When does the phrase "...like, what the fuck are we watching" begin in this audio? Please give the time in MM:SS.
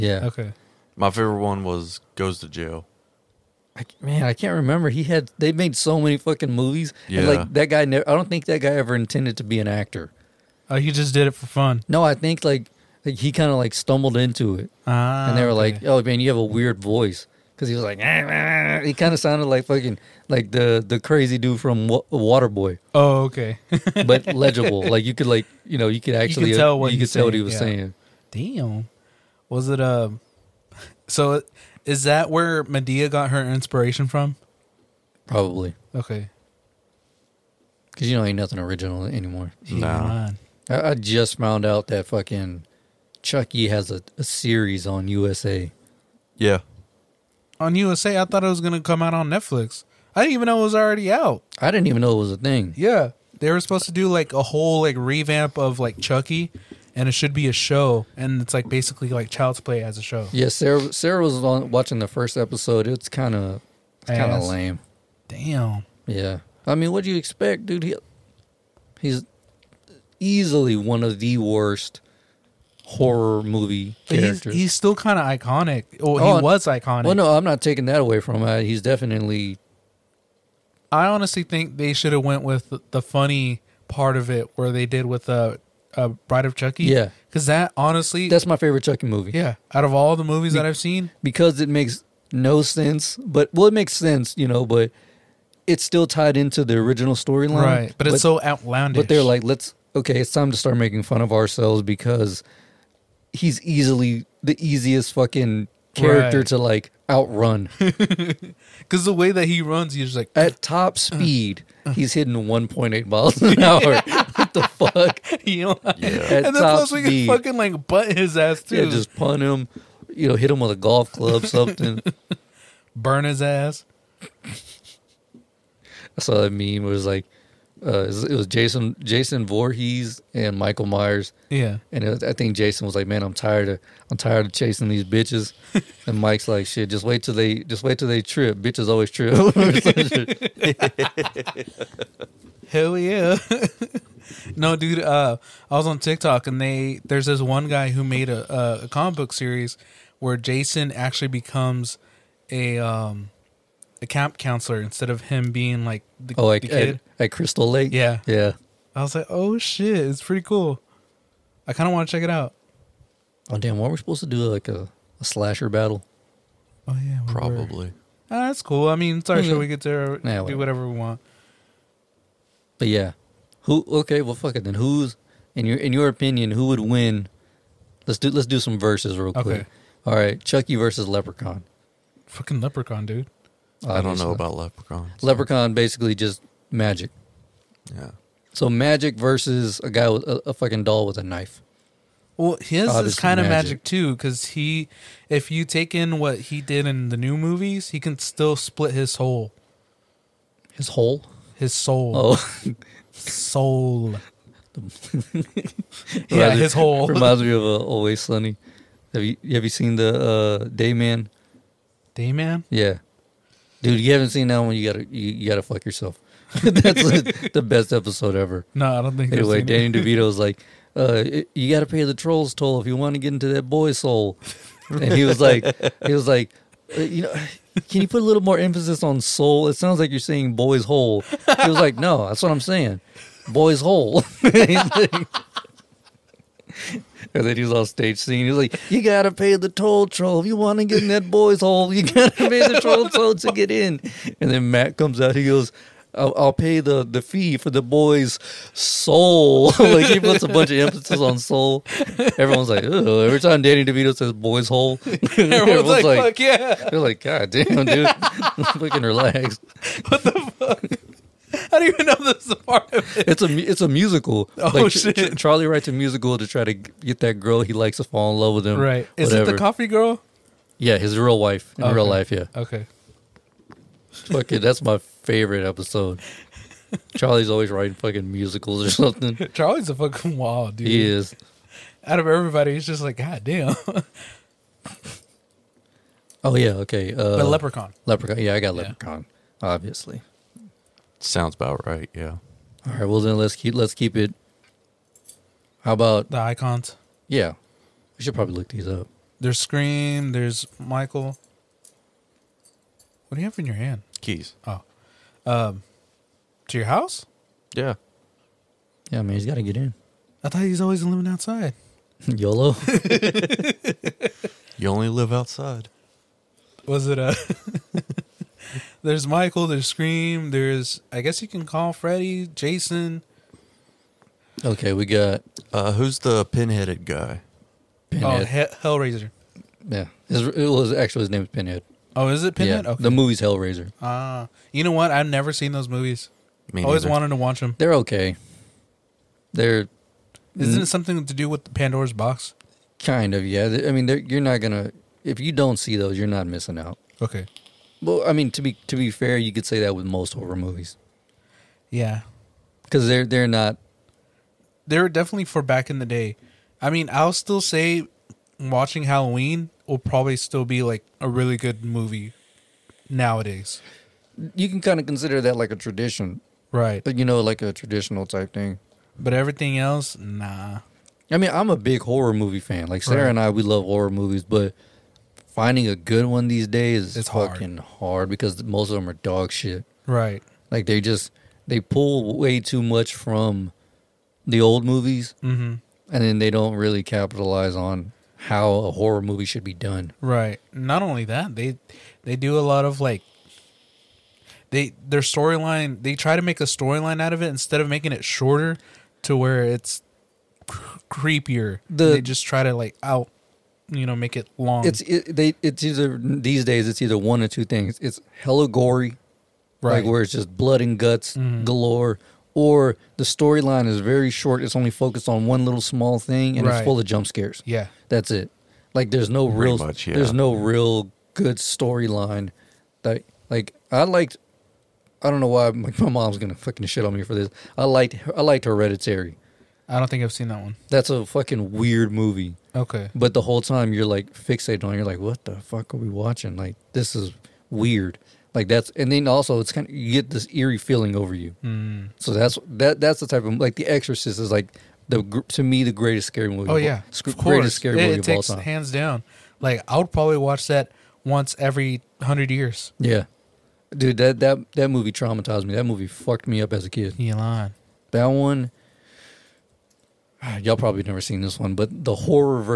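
07:15.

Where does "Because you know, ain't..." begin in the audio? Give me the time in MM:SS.
00:37.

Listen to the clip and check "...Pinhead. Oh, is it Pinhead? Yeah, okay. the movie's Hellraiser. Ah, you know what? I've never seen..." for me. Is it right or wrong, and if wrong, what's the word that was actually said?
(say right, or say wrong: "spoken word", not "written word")
right.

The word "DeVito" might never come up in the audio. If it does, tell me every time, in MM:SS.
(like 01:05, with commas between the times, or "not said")
03:39, 04:13.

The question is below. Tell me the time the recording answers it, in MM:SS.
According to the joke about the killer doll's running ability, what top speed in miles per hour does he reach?
01:52.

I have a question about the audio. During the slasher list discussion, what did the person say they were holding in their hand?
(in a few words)
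Keys.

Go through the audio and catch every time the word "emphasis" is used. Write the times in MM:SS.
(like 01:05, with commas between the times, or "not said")
03:48, 04:10.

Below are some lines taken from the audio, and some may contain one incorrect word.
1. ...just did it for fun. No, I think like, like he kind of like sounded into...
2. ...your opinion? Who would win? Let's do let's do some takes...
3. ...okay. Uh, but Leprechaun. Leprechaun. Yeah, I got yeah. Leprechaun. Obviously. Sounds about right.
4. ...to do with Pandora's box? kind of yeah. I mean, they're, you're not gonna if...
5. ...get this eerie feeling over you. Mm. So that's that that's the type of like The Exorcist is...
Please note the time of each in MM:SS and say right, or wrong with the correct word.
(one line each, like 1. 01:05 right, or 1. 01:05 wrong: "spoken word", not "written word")
1. 00:10 wrong: "stumbled", not "sounded"
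2. 02:55 wrong: "verses", not "takes"
3. 04:46 right
4. 05:41 right
5. 07:20 right.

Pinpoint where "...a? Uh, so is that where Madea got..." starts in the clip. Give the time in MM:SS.
00:29.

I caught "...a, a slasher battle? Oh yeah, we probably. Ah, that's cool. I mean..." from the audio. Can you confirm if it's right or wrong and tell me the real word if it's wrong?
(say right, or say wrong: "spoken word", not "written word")
right.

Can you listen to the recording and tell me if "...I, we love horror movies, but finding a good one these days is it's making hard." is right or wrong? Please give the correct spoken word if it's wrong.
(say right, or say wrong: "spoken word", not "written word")
wrong: "fucking", not "making".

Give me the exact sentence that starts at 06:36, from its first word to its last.
They try to make a storyline out of it instead of making it shorter to where it's creepier.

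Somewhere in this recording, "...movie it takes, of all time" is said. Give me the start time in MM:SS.
07:28.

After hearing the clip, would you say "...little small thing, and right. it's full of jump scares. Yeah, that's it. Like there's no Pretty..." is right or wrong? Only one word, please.
right.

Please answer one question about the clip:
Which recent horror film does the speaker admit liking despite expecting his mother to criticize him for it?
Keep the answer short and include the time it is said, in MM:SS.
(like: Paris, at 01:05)
Hereditary, at 07:08.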